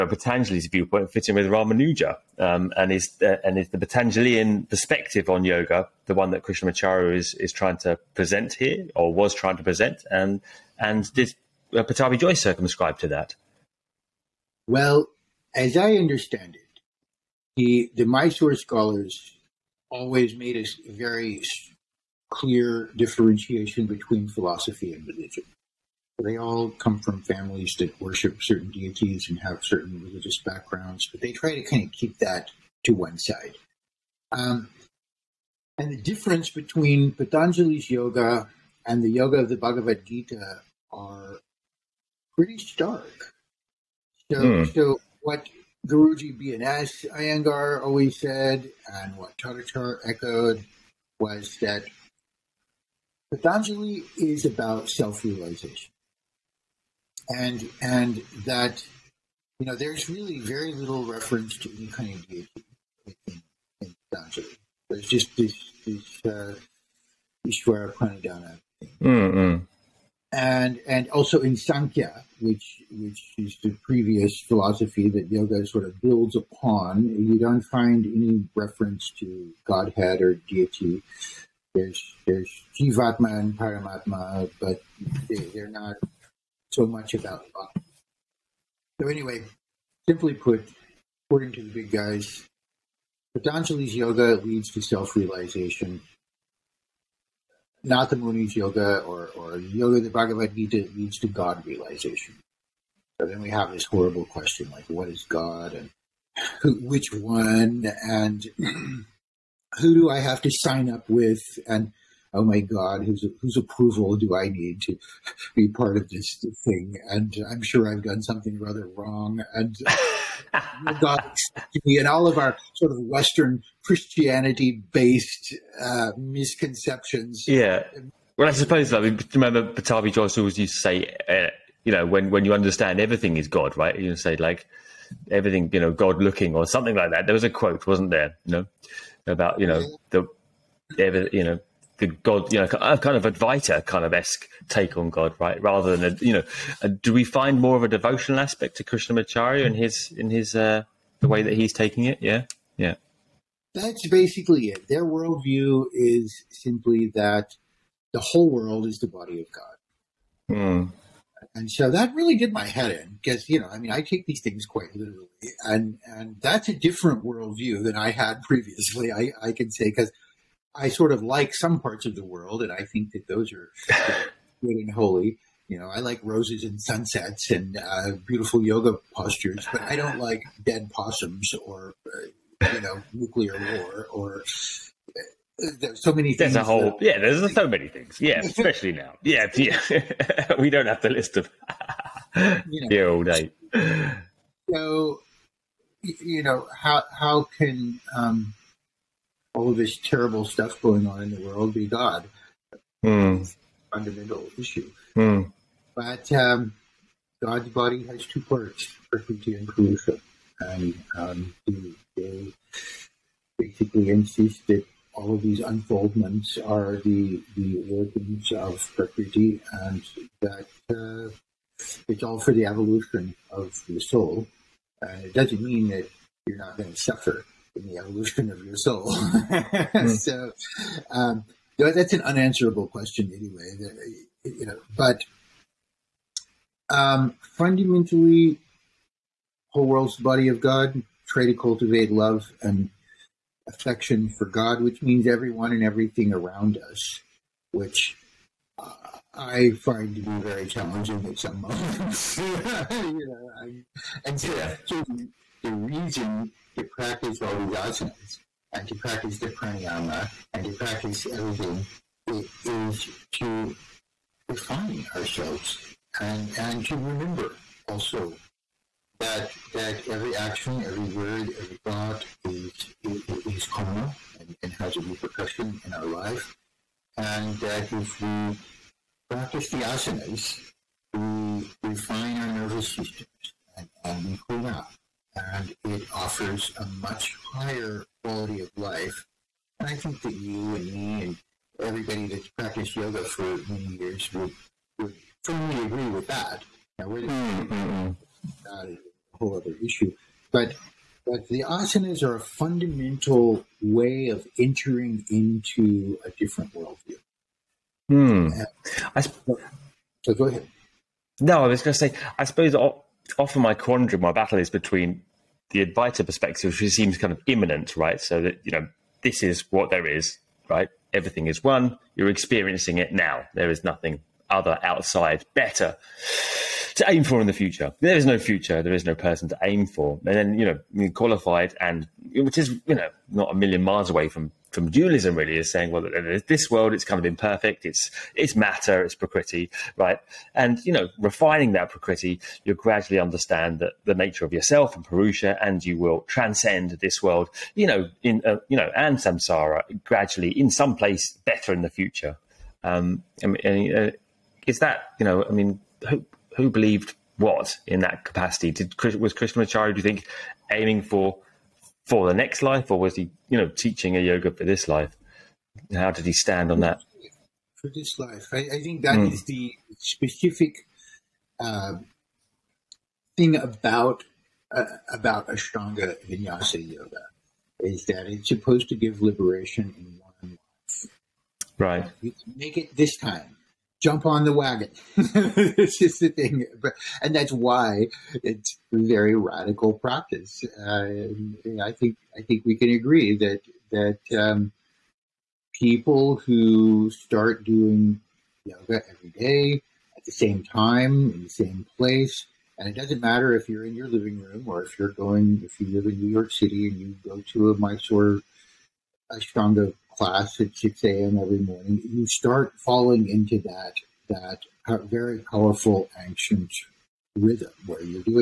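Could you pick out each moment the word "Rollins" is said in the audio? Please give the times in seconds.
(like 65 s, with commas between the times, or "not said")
not said.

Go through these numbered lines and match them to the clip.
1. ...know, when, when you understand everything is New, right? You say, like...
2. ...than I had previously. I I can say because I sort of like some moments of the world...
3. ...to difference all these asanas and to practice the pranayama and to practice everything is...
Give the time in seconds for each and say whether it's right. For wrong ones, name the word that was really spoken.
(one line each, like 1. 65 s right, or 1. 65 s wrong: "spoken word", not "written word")
1. 131 s wrong: "God", not "New"
2. 167 s wrong: "parts", not "moments"
3. 256 s wrong: "practice", not "difference".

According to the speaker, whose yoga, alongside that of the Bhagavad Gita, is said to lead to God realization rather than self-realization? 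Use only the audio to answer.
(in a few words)
Natha Muni.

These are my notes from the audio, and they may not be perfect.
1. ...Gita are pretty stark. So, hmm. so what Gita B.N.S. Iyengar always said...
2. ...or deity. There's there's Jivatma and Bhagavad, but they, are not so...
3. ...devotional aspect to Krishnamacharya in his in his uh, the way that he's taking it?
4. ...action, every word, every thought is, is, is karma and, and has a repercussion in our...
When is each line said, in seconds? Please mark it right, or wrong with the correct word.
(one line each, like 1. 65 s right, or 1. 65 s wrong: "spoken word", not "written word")
1. 40 s wrong: "Guruji", not "Gita"
2. 80 s wrong: "Paramatma", not "Bhagavad"
3. 147 s right
4. 270 s right.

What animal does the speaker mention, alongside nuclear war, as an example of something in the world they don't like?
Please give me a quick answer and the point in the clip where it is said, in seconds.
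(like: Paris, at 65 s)
Possums, at 180 s.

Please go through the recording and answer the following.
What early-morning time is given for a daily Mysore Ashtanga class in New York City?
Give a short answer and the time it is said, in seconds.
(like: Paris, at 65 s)
6 a.m., at 410 s.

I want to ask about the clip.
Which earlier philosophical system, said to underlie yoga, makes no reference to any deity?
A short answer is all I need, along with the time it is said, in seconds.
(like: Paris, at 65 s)
Sankhya, at 71 s.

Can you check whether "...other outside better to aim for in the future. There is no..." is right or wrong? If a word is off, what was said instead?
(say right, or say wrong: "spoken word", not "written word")
right.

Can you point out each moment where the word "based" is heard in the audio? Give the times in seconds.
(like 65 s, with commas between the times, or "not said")
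124 s.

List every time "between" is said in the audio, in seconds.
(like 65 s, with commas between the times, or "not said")
23 s, 36 s, 314 s.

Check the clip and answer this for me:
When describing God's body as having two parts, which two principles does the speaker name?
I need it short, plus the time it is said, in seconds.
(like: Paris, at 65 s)
Prakriti and Purusha, at 209 s.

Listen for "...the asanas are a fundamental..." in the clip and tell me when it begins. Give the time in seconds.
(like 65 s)
301 s.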